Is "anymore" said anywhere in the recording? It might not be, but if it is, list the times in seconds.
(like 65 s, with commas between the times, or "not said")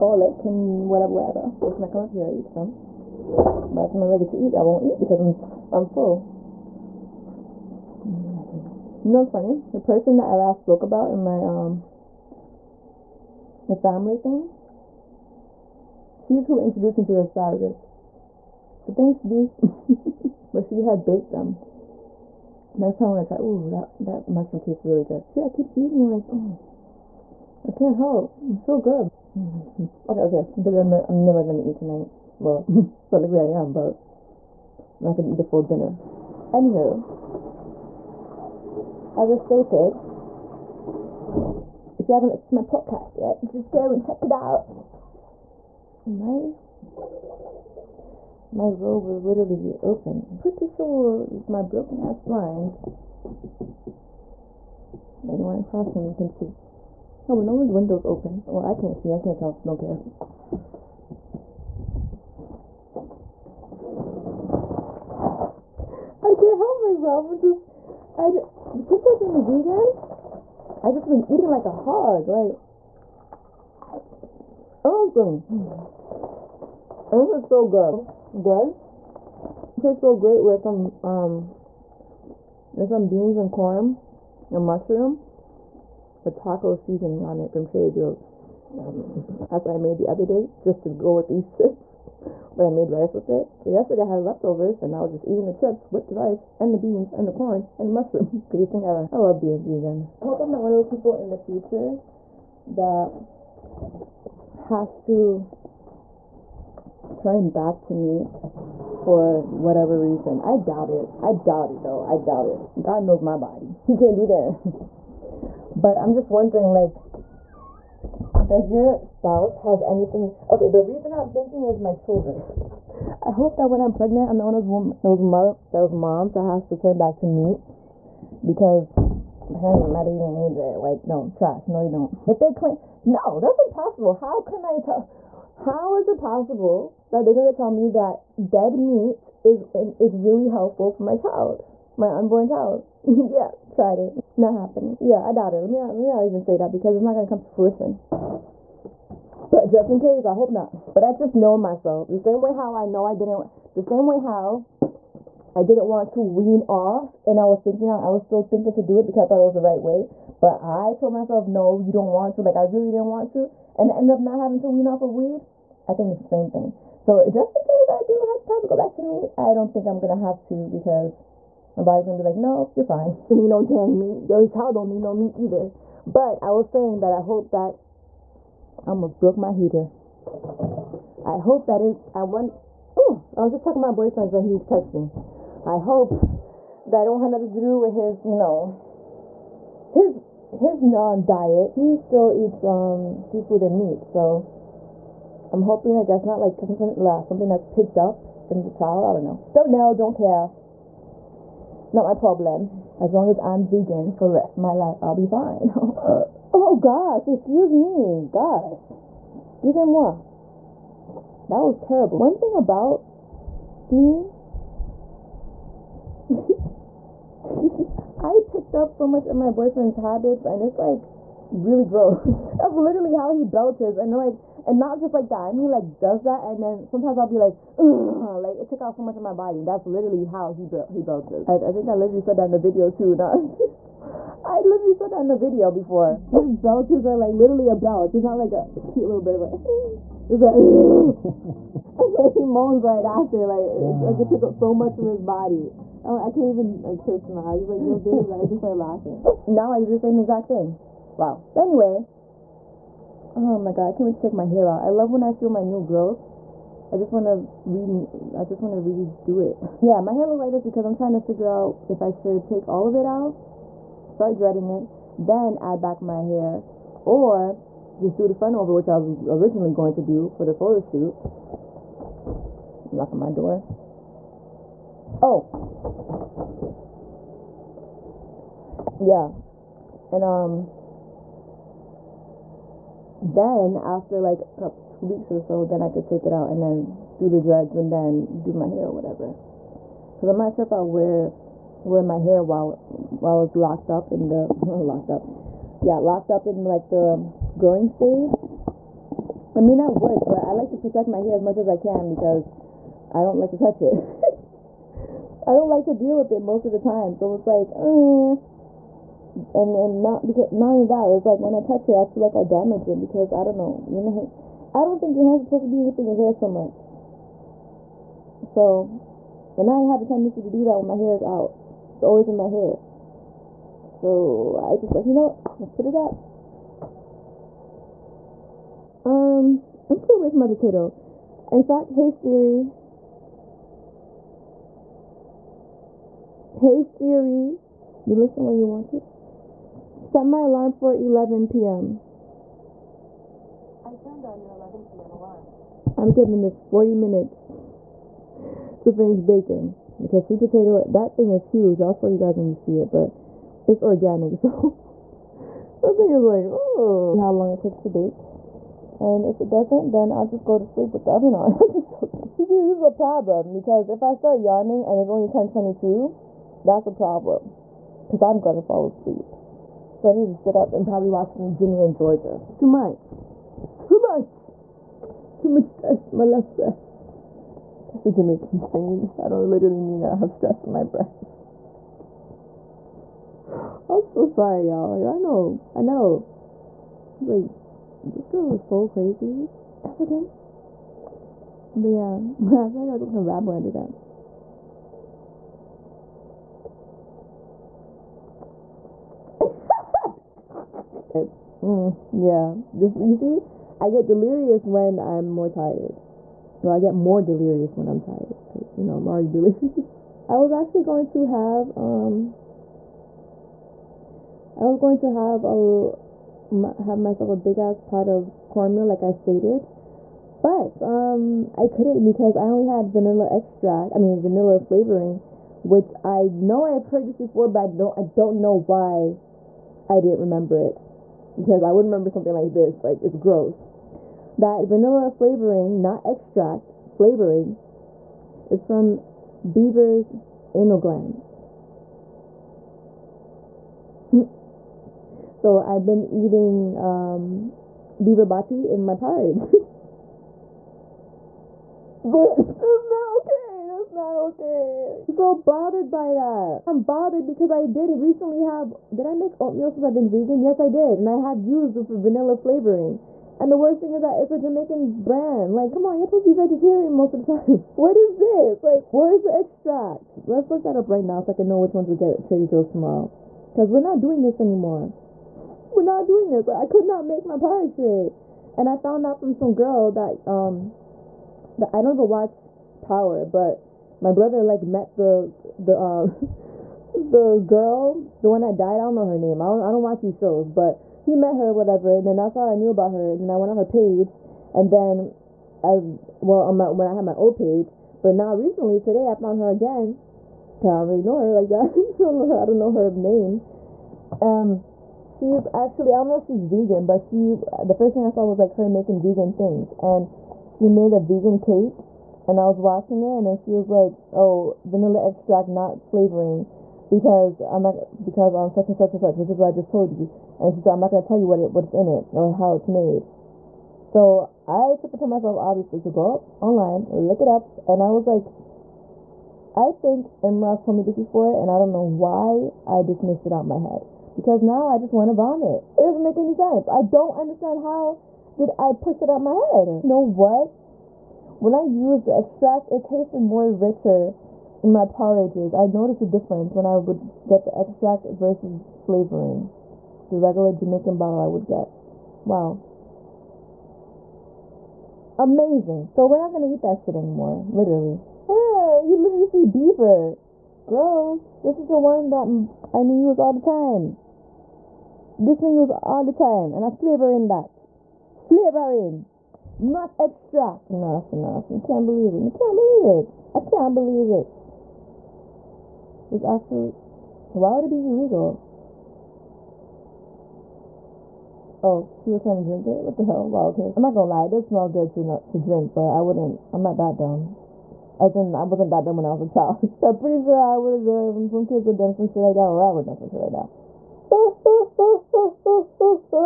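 474 s, 556 s.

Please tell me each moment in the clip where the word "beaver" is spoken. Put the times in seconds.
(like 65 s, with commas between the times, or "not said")
439 s, 448 s, 559 s.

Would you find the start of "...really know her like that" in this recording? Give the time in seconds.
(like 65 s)
500 s.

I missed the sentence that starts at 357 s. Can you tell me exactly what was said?
See how long it takes to bake.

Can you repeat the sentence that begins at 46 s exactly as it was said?
My my robe was literally open.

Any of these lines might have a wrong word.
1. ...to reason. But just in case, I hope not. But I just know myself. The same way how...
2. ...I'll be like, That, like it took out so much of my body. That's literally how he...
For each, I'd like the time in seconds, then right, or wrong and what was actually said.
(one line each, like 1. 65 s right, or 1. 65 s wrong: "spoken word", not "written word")
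1. 147 s wrong: "fruition", not "reason"
2. 227 s wrong: "Ugh", not "That".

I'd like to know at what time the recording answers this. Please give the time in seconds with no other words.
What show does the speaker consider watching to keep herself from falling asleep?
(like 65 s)
371 s.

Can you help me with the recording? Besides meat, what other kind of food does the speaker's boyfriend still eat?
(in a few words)
seafood.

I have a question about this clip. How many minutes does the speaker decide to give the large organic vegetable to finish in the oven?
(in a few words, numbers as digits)
40.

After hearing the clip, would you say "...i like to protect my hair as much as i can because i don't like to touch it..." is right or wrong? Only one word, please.
right.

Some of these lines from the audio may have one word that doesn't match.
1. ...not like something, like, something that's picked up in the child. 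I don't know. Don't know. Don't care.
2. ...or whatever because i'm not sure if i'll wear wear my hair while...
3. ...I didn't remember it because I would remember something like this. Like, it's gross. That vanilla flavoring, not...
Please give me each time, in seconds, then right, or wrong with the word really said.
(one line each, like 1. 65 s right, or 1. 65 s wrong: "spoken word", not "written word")
1. 196 s right
2. 288 s right
3. 429 s right.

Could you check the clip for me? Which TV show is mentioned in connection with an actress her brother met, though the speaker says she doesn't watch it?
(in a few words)
Power.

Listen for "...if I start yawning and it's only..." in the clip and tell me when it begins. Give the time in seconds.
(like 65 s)
363 s.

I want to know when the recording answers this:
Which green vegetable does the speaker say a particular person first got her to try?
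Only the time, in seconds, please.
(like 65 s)
17 s.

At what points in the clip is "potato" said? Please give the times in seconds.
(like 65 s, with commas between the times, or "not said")
330 s, 350 s.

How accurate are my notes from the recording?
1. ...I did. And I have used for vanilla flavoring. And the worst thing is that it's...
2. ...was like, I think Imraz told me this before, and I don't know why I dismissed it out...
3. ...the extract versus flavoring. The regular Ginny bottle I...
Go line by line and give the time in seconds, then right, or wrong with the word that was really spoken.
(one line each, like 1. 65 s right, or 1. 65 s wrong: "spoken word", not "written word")
1. 460 s right
2. 527 s right
3. 547 s wrong: "Jamaican", not "Ginny".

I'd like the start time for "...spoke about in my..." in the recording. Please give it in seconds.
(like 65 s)
10 s.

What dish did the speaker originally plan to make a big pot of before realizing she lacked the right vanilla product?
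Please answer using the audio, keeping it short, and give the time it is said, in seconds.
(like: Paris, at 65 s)
cornmeal, at 418 s.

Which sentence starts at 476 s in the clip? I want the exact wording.
I could not make my porridge today.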